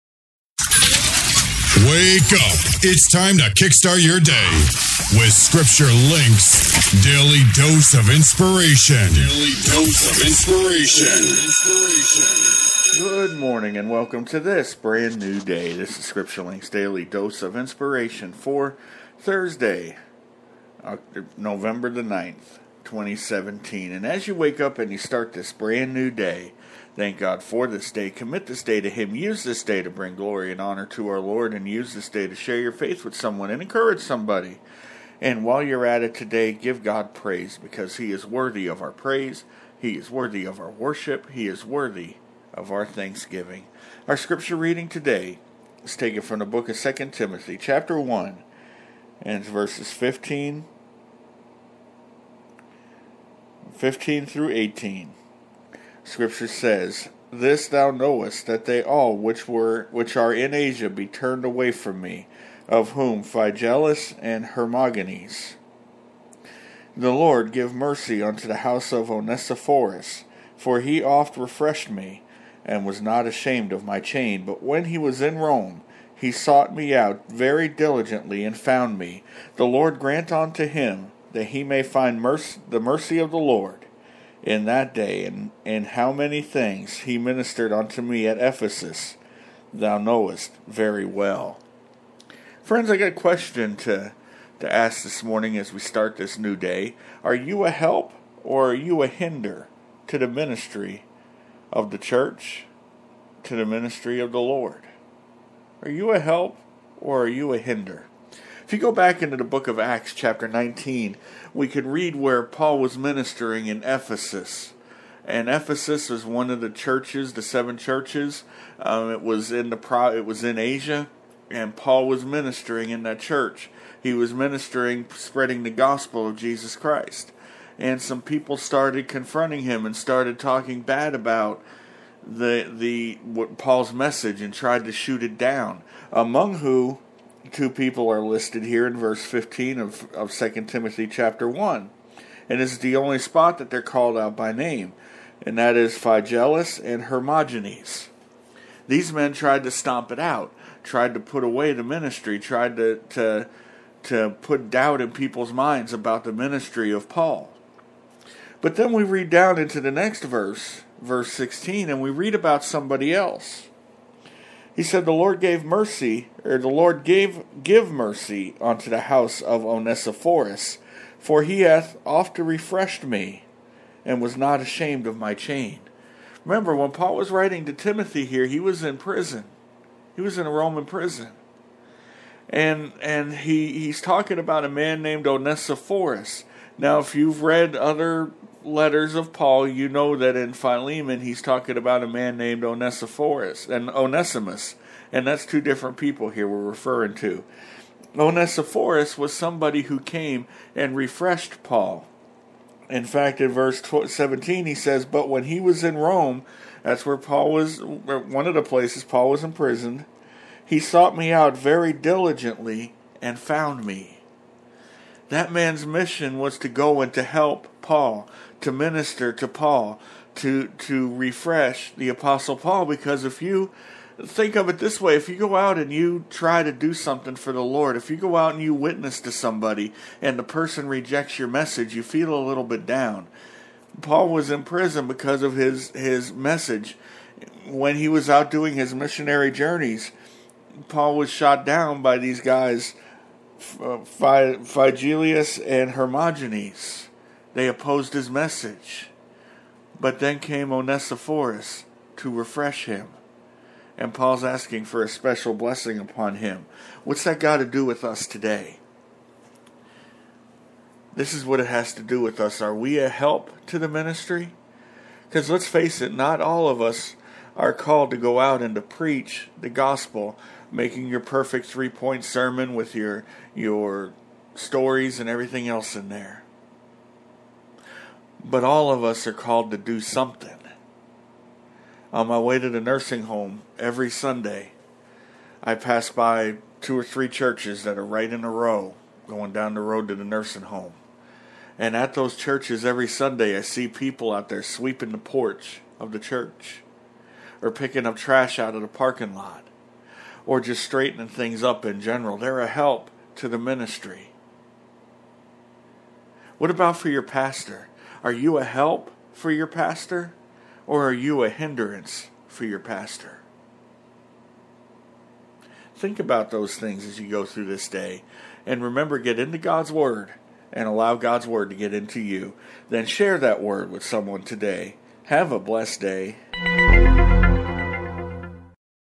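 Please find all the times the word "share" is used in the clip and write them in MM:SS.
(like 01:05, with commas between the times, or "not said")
00:32, 05:23.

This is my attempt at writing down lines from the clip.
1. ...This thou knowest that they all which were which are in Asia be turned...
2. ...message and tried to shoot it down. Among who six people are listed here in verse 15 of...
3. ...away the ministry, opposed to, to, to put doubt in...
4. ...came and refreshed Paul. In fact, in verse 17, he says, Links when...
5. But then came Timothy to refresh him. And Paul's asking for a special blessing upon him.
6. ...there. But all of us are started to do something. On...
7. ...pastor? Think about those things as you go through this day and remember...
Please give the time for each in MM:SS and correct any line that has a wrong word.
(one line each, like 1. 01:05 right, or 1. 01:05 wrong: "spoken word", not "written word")
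1. 00:57 right
2. 02:13 wrong: "two", not "six"
3. 02:31 wrong: "tried", not "opposed"
4. 03:19 wrong: "But", not "Links"
5. 04:09 wrong: "Onesiphorus", not "Timothy"
6. 04:36 wrong: "called", not "started"
7. 05:12 right.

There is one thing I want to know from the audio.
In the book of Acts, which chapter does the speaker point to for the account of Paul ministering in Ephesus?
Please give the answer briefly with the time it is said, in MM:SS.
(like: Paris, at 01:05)
Chapter 19, at 01:50.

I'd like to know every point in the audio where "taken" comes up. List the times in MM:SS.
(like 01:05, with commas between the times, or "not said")
00:45.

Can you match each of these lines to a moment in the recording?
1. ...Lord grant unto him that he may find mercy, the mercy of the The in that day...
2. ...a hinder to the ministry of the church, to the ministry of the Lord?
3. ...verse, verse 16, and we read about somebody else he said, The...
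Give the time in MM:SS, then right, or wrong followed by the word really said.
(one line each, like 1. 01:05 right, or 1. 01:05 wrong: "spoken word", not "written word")
1. 01:19 wrong: "Lord", not "The"
2. 01:39 right
3. 02:40 right.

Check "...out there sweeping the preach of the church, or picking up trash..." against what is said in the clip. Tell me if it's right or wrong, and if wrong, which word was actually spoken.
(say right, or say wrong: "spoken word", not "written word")
wrong: "porch", not "preach".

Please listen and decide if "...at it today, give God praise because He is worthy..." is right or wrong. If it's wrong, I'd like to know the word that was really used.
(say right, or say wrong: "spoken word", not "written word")
right.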